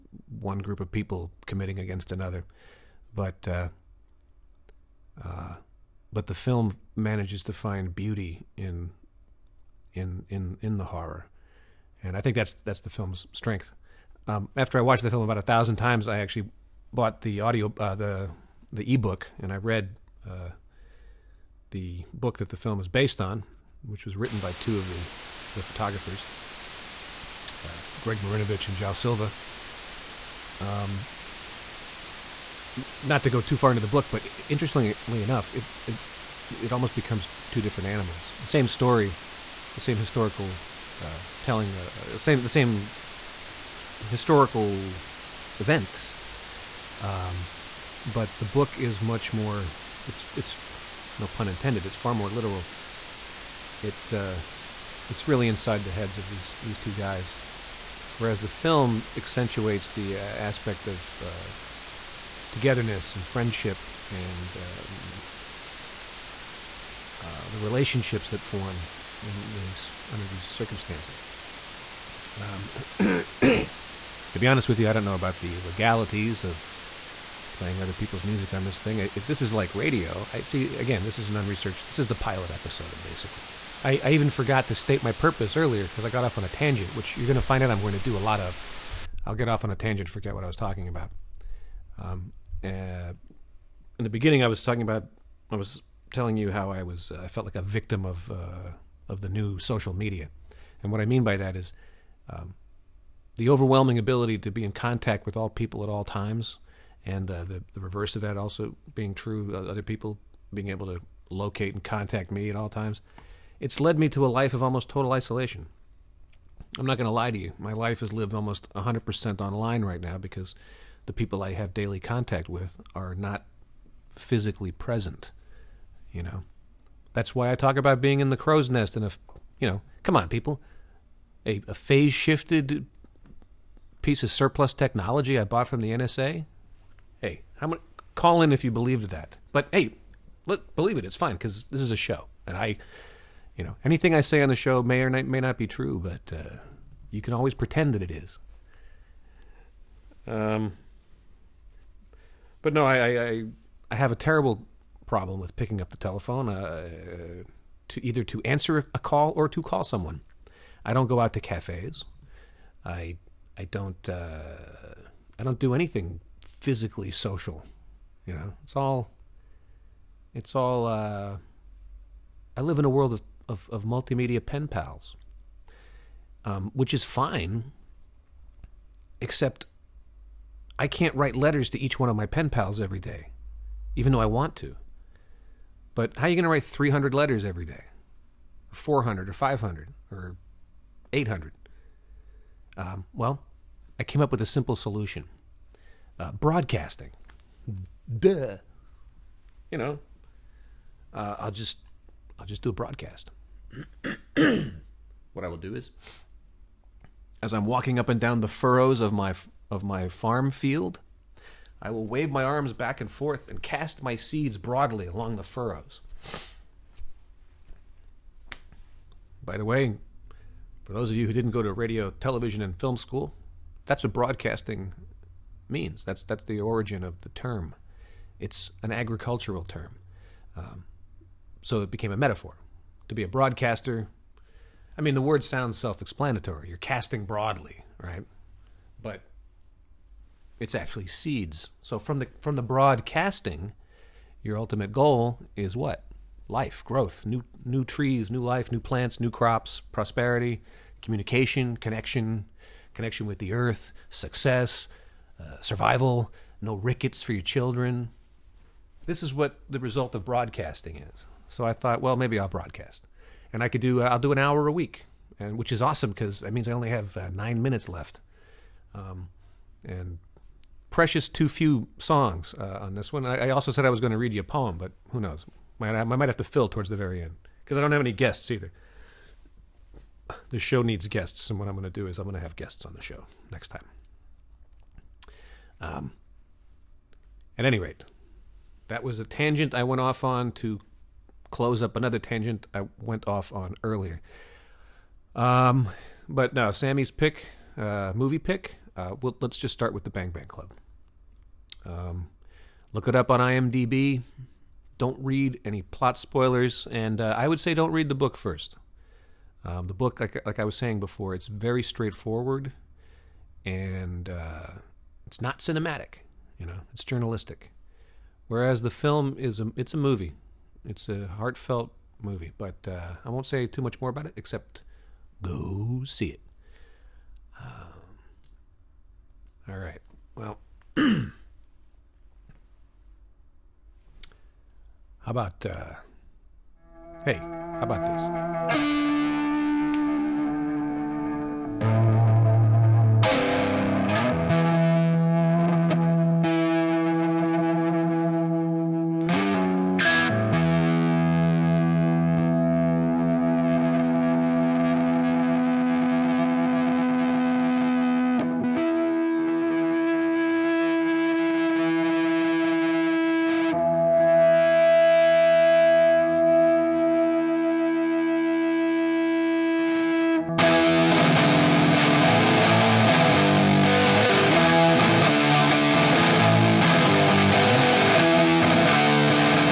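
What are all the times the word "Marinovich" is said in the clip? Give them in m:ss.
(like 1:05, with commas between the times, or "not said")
0:28.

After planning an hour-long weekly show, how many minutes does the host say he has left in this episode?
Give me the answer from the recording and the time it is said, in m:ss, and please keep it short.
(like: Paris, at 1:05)
9, at 4:27.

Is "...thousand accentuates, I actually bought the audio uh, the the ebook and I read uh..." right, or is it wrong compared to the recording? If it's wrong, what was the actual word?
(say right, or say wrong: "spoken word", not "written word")
wrong: "times", not "accentuates".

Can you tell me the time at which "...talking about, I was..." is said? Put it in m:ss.
1:34.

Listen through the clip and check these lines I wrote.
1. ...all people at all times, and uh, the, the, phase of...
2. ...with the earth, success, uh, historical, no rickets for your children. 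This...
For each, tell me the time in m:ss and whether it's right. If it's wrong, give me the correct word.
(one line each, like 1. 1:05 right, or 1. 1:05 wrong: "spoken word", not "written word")
1. 1:45 wrong: "reverse", not "phase"
2. 4:13 wrong: "survival", not "historical".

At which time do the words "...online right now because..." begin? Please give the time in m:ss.
1:59.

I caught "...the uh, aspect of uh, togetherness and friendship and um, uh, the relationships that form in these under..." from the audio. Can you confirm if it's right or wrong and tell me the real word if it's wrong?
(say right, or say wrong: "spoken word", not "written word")
right.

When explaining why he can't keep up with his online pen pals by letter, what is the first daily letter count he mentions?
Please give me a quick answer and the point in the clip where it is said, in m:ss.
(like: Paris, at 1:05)
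300, at 3:06.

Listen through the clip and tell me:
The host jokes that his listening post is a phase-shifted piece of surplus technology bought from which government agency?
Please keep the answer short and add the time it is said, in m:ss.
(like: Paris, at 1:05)
NSA, at 2:15.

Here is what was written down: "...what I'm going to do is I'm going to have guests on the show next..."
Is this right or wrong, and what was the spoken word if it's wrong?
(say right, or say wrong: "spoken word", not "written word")
right.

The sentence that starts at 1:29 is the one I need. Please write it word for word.
I'll get off on a tangent, forget what I was talking about.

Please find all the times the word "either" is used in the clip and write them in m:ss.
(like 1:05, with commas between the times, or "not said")
2:38, 4:38.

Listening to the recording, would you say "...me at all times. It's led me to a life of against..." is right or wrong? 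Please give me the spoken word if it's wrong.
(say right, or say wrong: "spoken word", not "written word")
wrong: "almost", not "against".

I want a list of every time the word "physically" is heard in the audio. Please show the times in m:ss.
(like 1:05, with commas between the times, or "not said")
2:04, 2:46.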